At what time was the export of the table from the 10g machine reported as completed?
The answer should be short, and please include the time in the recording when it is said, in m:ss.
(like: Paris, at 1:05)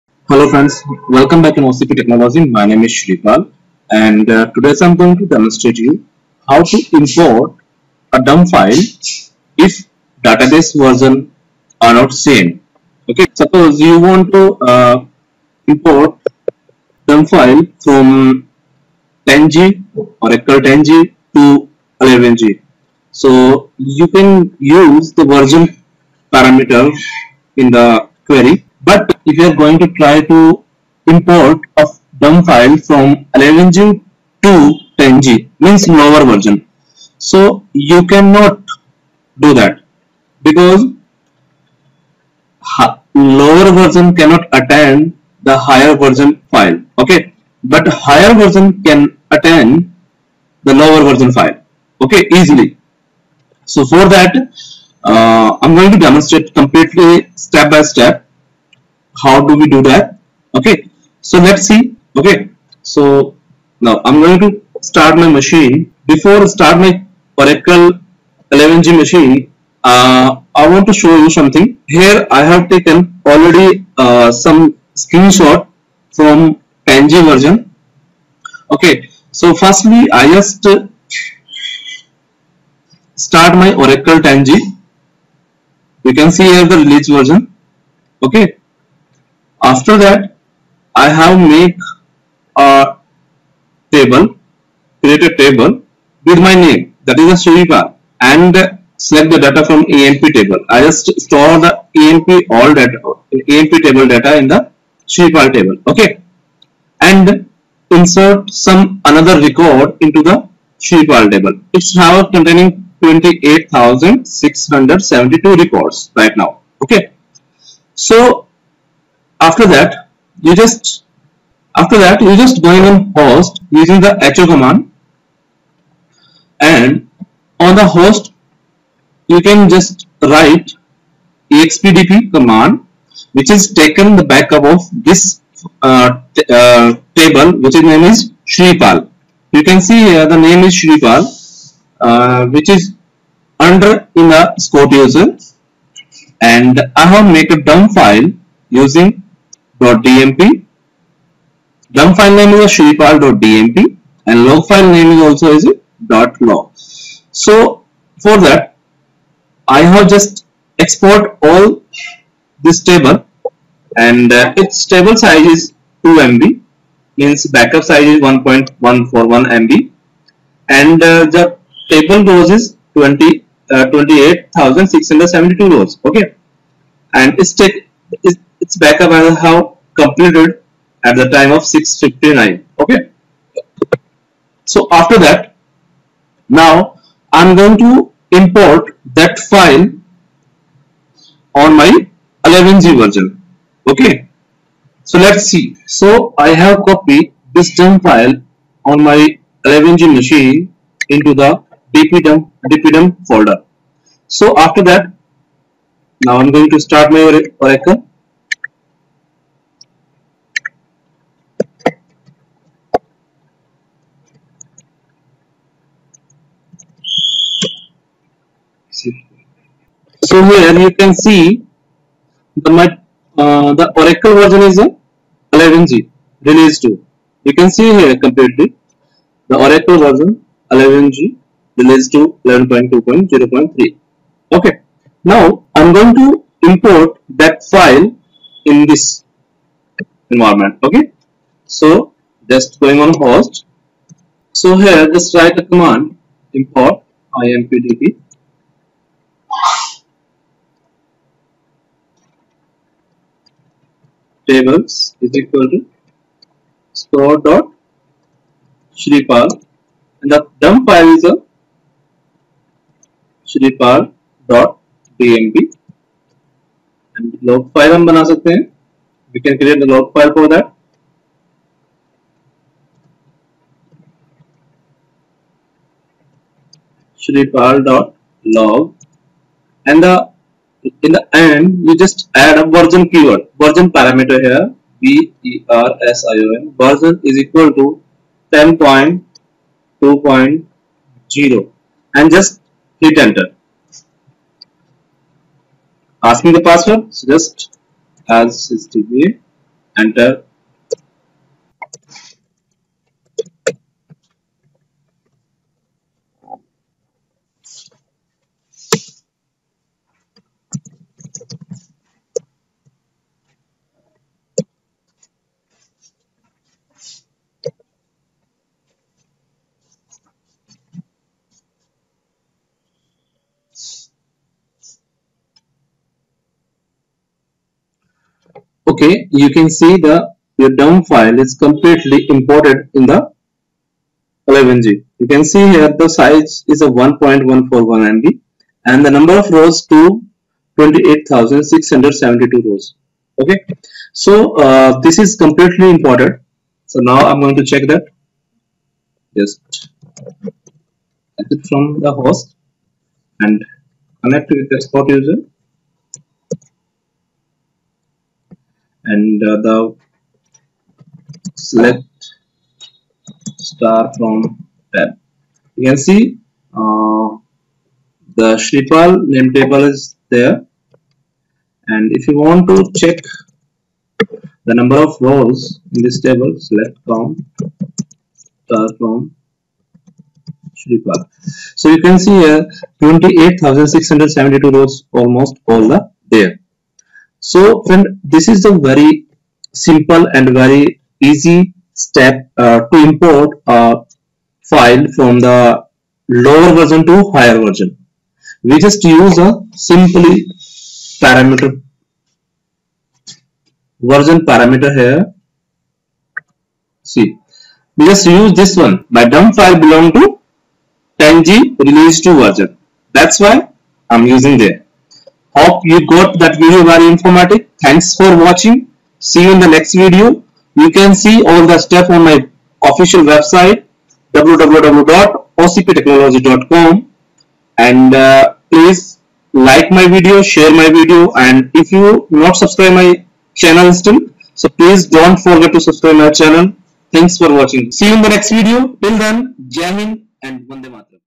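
6.59, at 3:01.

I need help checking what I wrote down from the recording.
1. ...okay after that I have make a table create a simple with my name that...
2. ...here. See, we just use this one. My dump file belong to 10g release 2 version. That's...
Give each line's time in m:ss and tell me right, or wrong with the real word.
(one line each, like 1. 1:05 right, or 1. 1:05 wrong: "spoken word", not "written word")
1. 1:28 wrong: "table", not "simple"
2. 6:44 right.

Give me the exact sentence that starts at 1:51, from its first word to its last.
It's now containing 28,672 records right now okay.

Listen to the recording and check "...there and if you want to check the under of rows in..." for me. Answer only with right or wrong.
wrong.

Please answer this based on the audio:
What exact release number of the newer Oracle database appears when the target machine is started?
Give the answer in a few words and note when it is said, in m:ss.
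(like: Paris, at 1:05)
11.2.0.3, at 3:52.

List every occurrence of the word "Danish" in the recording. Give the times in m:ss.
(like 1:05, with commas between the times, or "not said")
not said.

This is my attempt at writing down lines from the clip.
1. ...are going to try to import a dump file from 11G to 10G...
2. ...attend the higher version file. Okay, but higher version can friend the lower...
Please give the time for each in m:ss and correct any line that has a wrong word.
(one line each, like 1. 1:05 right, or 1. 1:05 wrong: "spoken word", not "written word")
1. 0:29 right
2. 0:44 wrong: "attend", not "friend".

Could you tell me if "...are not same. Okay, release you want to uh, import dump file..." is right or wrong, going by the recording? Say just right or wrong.
wrong.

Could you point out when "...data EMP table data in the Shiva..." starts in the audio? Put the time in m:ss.
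1:42.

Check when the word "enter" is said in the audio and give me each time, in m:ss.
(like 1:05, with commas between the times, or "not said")
4:53, 5:00.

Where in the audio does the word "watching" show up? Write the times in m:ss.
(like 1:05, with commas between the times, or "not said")
6:58, 7:17.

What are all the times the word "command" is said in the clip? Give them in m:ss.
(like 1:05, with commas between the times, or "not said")
2:04, 2:12, 4:05.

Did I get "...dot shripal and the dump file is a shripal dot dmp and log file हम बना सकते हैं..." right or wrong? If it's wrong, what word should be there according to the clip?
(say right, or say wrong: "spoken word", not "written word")
right.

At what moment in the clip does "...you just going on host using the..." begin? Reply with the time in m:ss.
2:02.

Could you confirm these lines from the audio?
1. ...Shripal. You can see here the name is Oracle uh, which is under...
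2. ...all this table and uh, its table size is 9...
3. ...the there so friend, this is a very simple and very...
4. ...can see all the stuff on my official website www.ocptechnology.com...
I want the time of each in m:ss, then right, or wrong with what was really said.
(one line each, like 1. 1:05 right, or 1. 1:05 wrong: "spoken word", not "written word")
1. 2:18 wrong: "Shripal", not "Oracle"
2. 2:41 wrong: "2", not "9"
3. 6:25 right
4. 7:00 right.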